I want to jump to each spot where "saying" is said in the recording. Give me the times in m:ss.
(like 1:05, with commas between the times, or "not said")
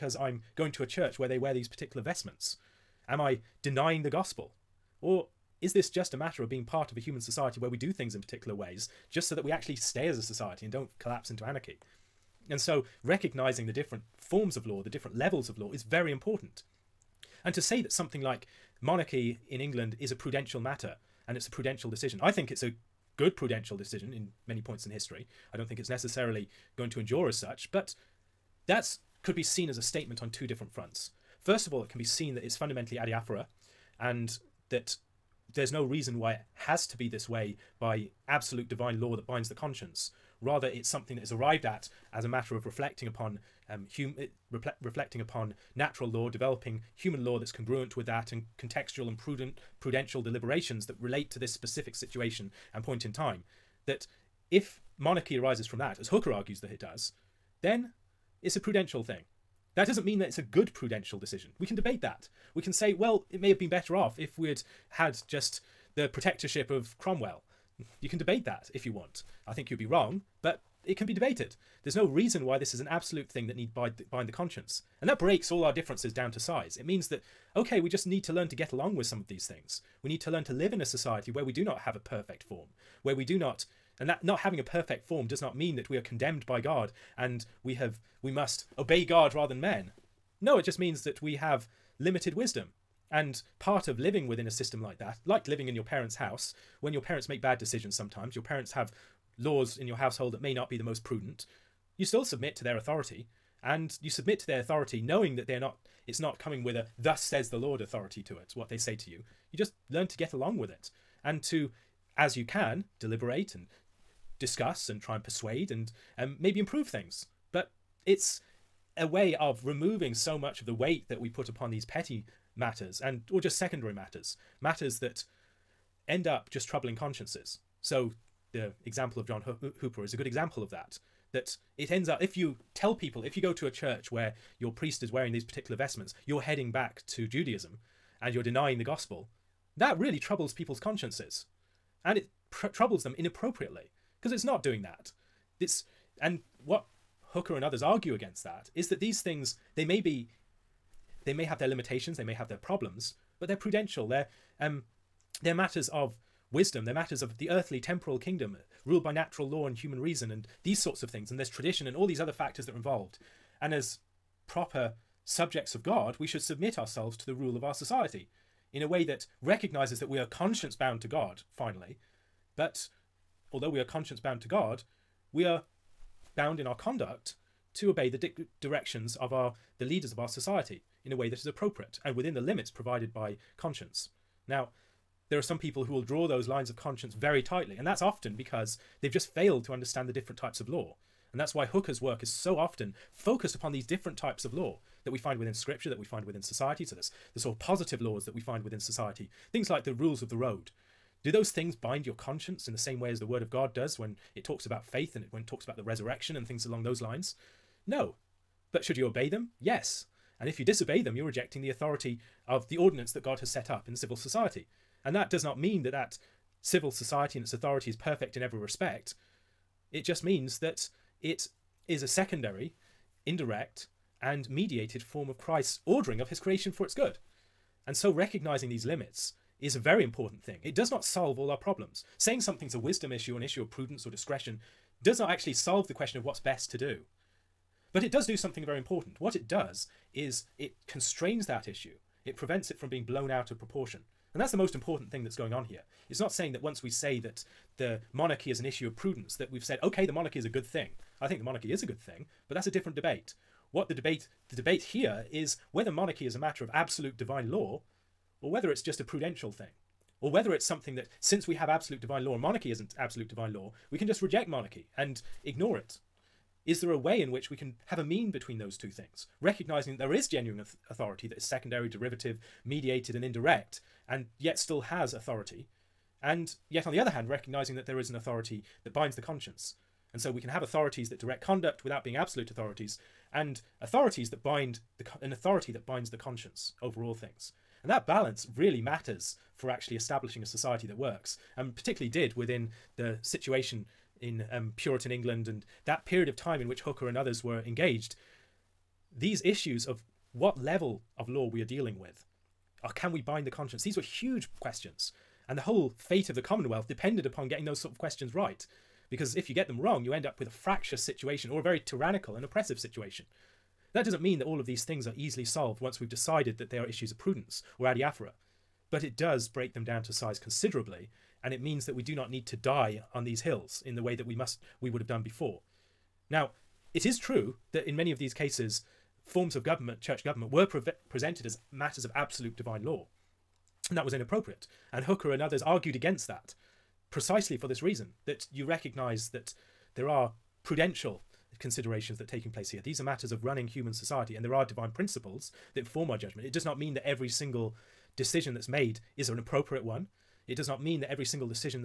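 3:52, 4:06.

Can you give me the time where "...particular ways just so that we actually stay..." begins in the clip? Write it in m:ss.
0:08.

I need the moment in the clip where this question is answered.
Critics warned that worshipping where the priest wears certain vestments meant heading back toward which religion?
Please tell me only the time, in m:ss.
2:17.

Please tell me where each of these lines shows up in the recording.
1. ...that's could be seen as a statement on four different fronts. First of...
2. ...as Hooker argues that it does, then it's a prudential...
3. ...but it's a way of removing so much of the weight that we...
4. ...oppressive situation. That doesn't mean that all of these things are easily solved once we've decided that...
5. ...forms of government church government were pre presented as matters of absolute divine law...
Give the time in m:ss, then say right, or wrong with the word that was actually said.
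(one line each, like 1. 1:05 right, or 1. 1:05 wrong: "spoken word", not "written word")
1. 0:28 wrong: "two", not "four"
2. 0:55 right
3. 1:57 right
4. 5:12 right
5. 5:29 right.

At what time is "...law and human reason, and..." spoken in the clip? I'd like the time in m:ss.
2:39.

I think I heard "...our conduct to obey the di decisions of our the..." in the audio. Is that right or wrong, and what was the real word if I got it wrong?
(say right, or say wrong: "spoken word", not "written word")
wrong: "directions", not "decisions".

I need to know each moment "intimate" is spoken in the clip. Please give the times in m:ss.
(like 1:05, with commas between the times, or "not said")
not said.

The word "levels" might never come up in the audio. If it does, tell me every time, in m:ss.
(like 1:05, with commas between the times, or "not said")
0:15, 5:00.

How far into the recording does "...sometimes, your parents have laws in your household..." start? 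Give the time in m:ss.
1:37.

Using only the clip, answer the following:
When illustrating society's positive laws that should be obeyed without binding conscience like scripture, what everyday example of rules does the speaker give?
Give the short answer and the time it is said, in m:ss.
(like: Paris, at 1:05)
rules of the road, at 3:19.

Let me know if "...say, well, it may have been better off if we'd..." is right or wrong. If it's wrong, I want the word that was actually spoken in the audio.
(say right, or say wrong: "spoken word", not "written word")
right.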